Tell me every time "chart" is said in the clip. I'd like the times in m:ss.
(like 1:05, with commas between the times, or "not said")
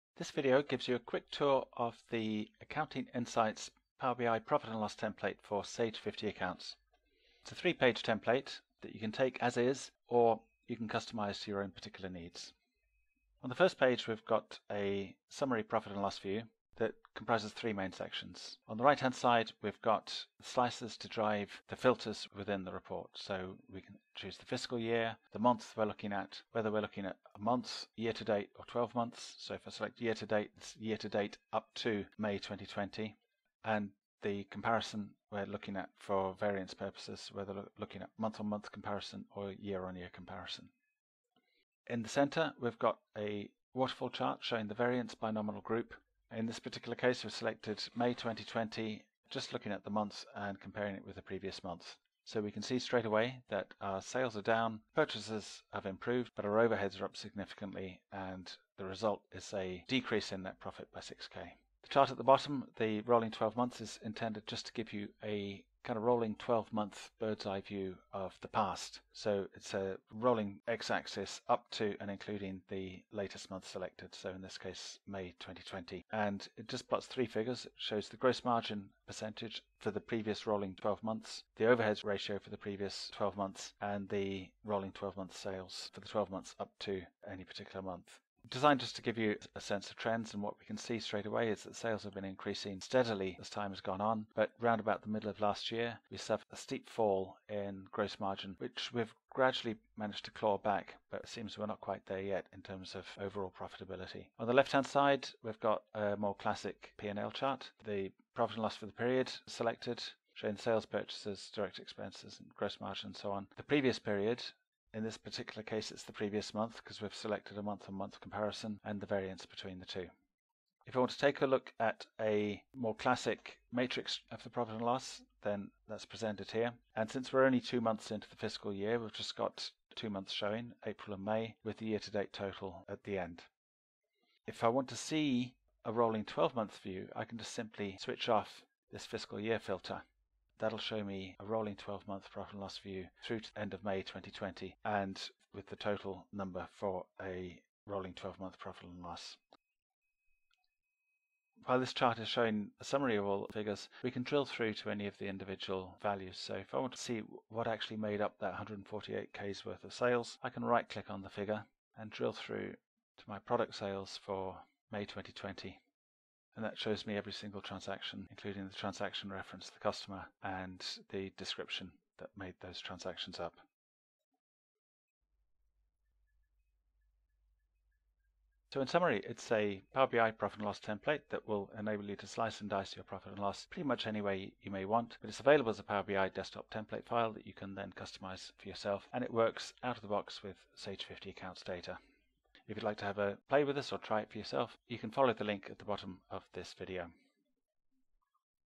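0:44, 1:01, 1:47, 2:31.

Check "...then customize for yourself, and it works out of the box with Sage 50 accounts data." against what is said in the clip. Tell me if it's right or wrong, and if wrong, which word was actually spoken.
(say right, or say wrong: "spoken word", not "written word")
right.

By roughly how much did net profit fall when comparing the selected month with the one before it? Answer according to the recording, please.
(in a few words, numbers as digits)
6k.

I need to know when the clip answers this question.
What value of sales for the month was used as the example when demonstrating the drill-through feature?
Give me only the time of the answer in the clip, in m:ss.
2:38.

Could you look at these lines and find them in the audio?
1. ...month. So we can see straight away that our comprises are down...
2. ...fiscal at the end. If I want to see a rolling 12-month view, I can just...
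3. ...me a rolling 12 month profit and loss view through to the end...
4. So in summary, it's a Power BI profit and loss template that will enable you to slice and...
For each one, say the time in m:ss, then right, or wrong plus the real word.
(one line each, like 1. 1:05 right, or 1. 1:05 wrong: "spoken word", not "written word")
1. 0:51 wrong: "sales", not "comprises"
2. 2:12 wrong: "total", not "fiscal"
3. 2:21 right
4. 2:58 right.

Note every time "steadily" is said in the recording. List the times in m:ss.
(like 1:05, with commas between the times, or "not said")
1:32.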